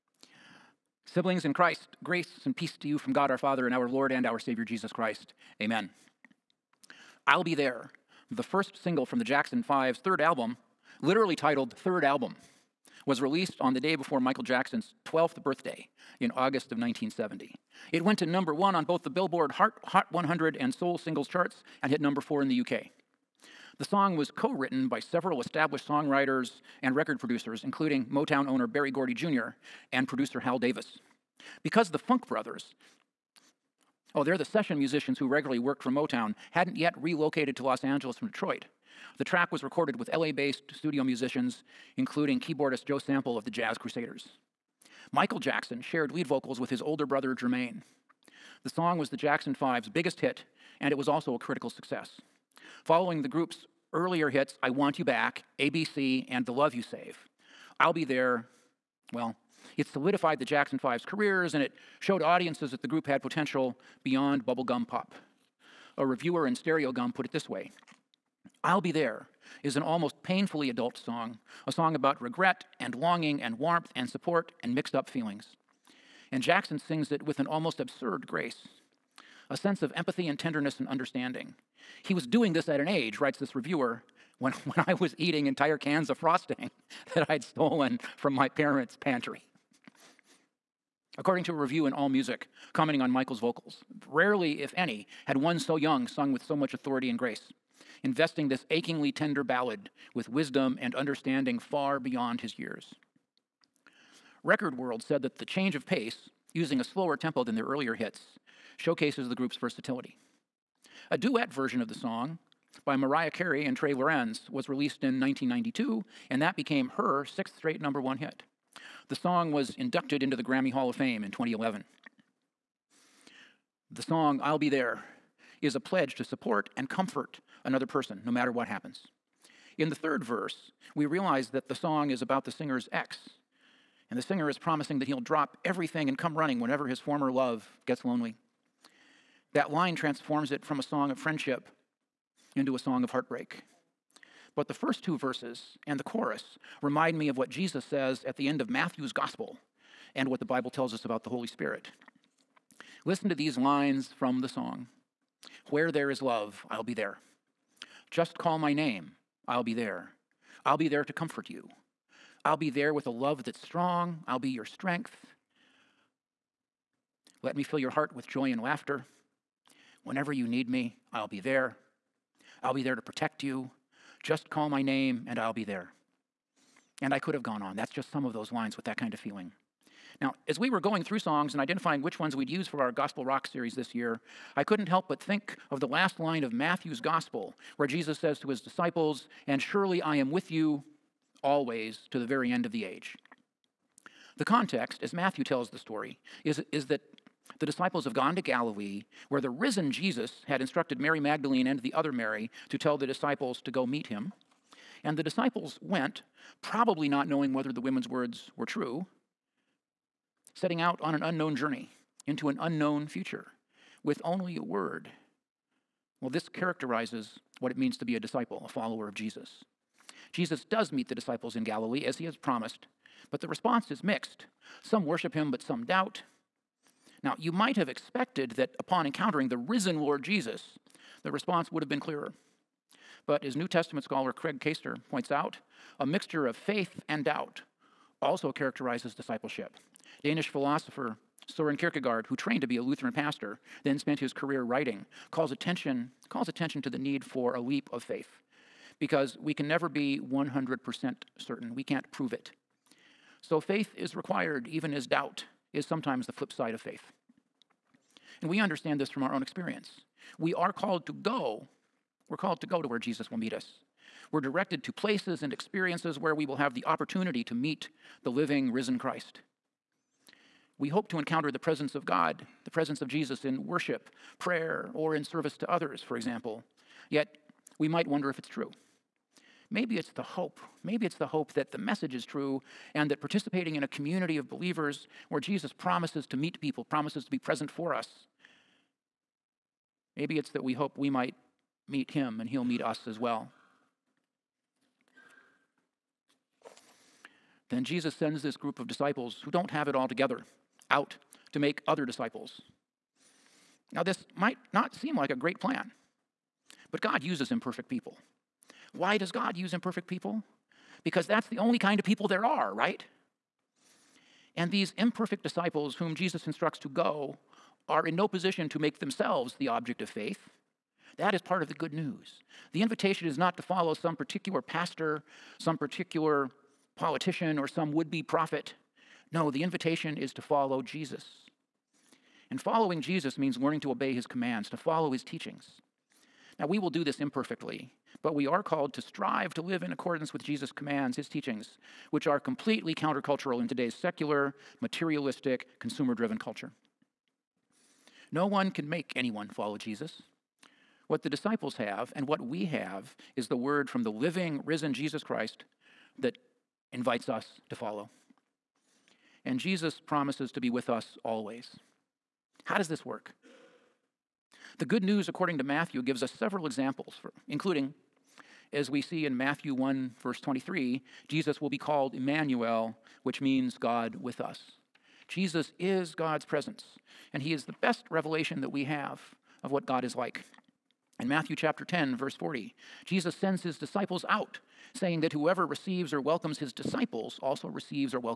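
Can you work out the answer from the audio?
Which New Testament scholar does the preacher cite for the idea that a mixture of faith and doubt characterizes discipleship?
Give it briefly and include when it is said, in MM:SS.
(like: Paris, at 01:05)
Craig Koester, at 03:54.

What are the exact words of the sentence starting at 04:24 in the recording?
We're directed to places and experiences where we will have the opportunity to meet the living, risen Christ.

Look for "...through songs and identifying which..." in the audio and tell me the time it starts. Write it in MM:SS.
03:01.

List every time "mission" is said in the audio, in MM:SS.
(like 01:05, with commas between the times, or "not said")
not said.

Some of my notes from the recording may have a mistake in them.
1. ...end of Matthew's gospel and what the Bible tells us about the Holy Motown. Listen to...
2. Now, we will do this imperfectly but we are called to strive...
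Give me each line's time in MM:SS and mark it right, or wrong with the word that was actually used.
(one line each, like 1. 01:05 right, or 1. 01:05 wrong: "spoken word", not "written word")
1. 02:28 wrong: "Spirit", not "Motown"
2. 05:36 right.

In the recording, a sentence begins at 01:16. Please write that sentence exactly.
And Jackson sings it with an almost absurd grace a sense of empathy and tenderness and understanding.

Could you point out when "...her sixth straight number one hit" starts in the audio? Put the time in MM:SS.
01:56.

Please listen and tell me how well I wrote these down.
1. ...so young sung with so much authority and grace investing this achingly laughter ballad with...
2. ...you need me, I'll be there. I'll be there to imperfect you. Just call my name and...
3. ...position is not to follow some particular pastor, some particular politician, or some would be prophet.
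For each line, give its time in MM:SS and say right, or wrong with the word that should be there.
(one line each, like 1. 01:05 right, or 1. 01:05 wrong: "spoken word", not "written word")
1. 01:35 wrong: "tender", not "laughter"
2. 02:50 wrong: "protect", not "imperfect"
3. 05:22 wrong: "invitation", not "position".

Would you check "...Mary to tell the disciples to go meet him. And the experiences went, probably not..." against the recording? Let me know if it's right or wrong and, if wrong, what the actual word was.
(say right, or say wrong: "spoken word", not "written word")
wrong: "disciples", not "experiences".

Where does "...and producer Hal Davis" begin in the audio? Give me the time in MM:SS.
00:29.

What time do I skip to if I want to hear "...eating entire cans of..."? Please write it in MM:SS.
01:25.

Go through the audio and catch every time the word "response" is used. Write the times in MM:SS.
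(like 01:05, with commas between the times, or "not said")
03:43, 03:51.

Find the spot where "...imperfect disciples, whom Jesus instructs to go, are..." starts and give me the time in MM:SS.
05:14.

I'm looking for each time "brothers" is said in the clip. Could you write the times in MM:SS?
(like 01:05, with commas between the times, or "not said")
00:32, 00:47.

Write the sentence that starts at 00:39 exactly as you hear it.
The track was recorded with LA based studio musicians, including keyboardist Joe Sample of the Jazz Crusaders.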